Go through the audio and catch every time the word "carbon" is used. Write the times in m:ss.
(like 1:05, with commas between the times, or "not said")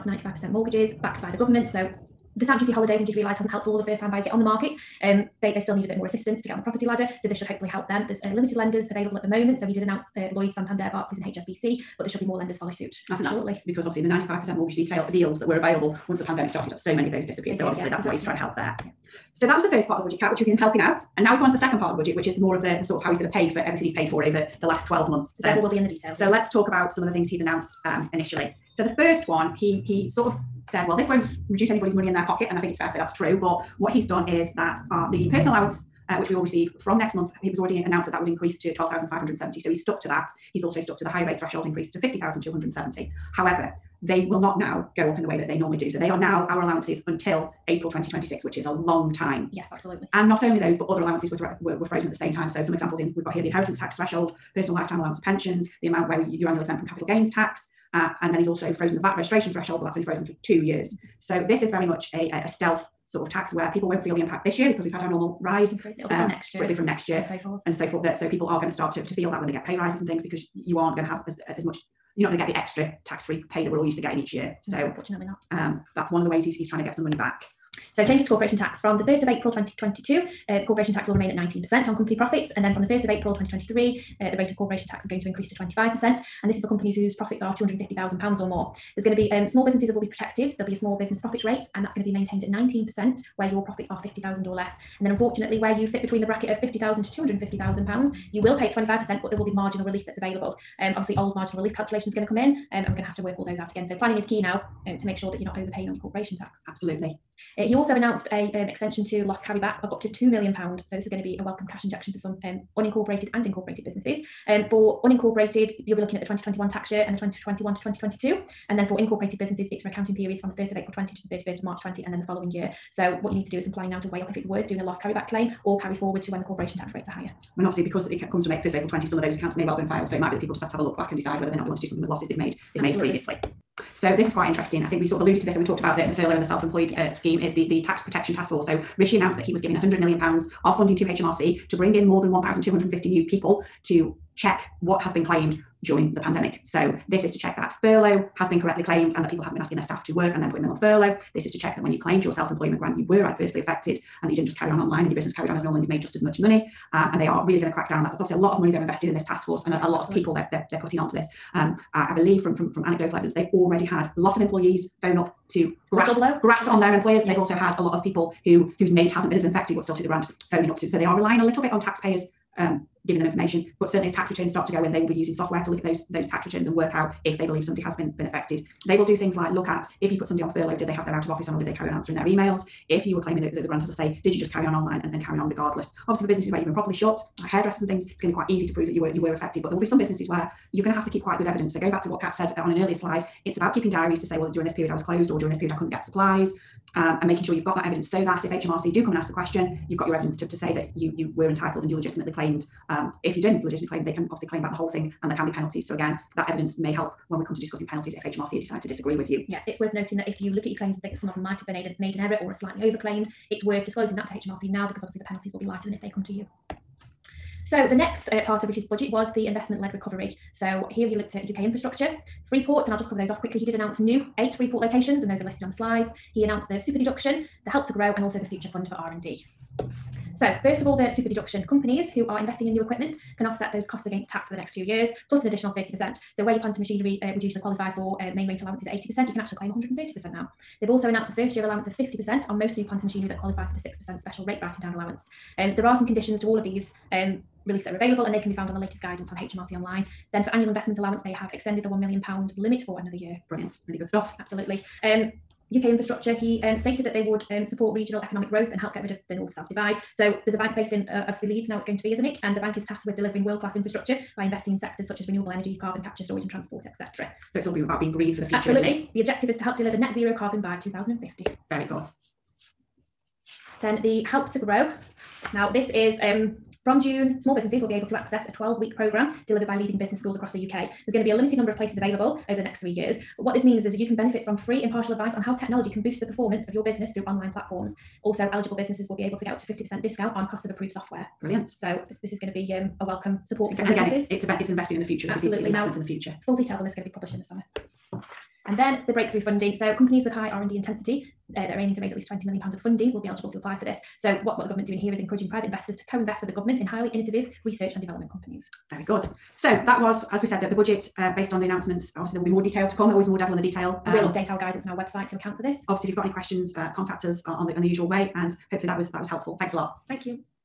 4:25, 4:30.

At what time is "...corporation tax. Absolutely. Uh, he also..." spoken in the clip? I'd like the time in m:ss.
1:46.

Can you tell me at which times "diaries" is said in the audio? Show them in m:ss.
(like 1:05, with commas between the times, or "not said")
3:13.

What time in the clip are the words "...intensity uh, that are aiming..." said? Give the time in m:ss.
5:00.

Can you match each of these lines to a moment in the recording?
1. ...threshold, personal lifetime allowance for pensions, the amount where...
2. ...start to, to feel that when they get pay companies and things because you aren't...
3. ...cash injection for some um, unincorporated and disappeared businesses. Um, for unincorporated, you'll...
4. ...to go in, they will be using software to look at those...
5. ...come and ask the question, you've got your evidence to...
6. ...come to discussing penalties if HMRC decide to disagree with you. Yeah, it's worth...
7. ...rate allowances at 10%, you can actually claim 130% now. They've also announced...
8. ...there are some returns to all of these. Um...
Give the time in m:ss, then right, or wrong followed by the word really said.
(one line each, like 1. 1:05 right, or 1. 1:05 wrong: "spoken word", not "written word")
1. 0:53 right
2. 1:08 wrong: "rises", not "companies"
3. 1:51 wrong: "incorporated", not "disappeared"
4. 2:54 right
5. 3:19 right
6. 3:27 right
7. 3:58 wrong: "80", not "10"
8. 4:05 wrong: "conditions", not "returns".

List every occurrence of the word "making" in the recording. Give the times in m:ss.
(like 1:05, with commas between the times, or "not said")
3:17.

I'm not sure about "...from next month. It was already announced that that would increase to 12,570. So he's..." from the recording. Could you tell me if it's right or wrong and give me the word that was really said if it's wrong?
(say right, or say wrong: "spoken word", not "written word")
right.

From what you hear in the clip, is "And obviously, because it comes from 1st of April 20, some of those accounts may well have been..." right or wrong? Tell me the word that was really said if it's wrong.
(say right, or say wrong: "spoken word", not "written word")
right.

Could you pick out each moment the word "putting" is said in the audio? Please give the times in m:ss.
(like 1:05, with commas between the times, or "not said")
2:30, 2:40.